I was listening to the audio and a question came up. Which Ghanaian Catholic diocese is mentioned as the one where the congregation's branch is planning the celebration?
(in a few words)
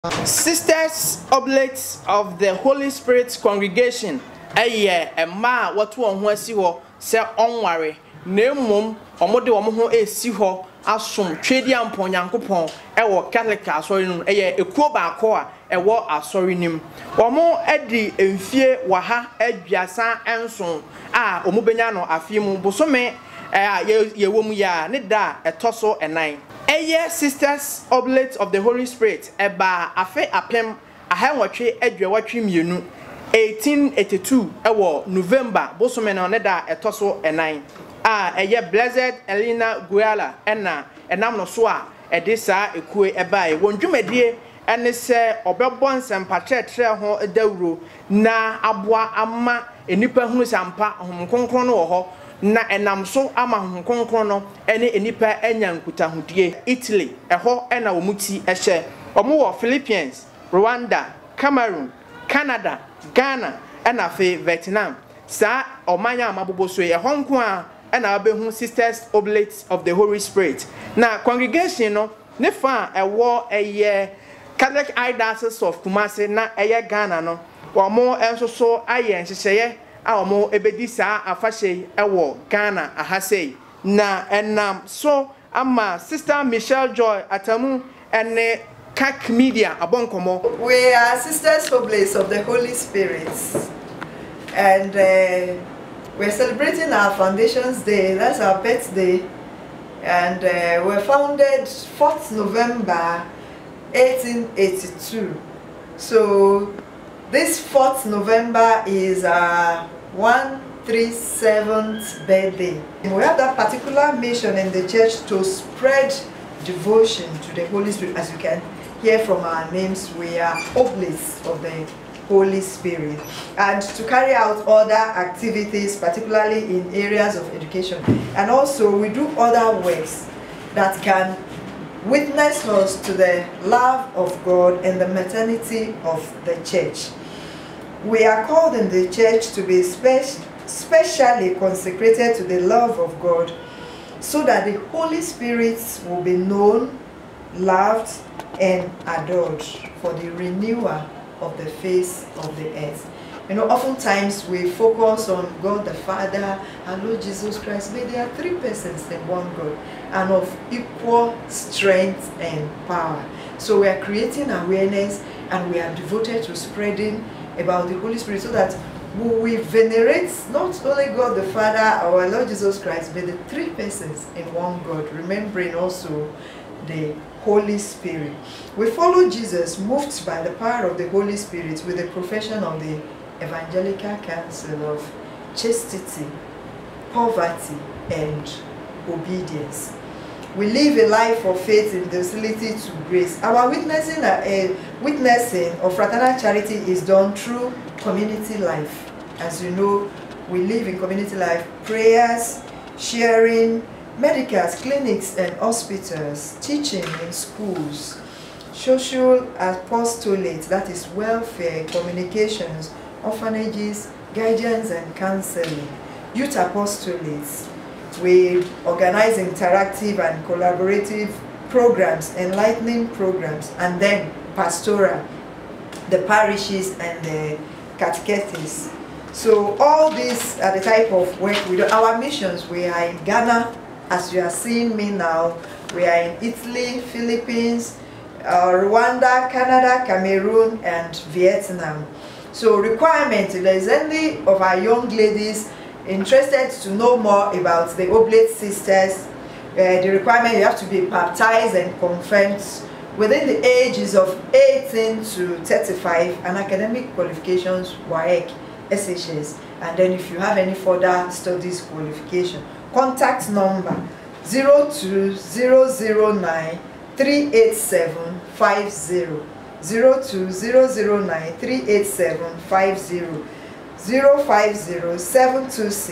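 Kumasi.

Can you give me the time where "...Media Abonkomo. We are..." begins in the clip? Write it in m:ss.
1:29.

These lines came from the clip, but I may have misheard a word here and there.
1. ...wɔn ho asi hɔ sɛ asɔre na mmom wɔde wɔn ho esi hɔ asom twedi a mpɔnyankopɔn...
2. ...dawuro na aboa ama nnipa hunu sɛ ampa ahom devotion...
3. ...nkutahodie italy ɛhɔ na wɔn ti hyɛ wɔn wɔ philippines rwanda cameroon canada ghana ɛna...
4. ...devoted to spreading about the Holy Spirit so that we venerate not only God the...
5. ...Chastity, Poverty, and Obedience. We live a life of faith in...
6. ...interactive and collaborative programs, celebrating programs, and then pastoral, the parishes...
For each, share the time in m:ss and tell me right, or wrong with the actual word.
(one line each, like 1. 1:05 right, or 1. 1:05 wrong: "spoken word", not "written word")
1. 0:06 wrong: "ɔnware", not "asɔre"
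2. 0:47 wrong: "kronkron", not "devotion"
3. 0:55 right
4. 2:45 right
5. 3:05 right
6. 3:39 wrong: "enlightening", not "celebrating".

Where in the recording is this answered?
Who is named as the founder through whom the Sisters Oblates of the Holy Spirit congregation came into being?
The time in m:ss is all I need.
0:38.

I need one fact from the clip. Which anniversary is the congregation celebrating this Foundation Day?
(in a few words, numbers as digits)
137th.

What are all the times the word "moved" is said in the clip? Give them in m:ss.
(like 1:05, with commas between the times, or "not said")
2:59.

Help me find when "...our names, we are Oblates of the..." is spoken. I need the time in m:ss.
1:59.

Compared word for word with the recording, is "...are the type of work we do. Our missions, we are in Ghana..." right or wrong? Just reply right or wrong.
right.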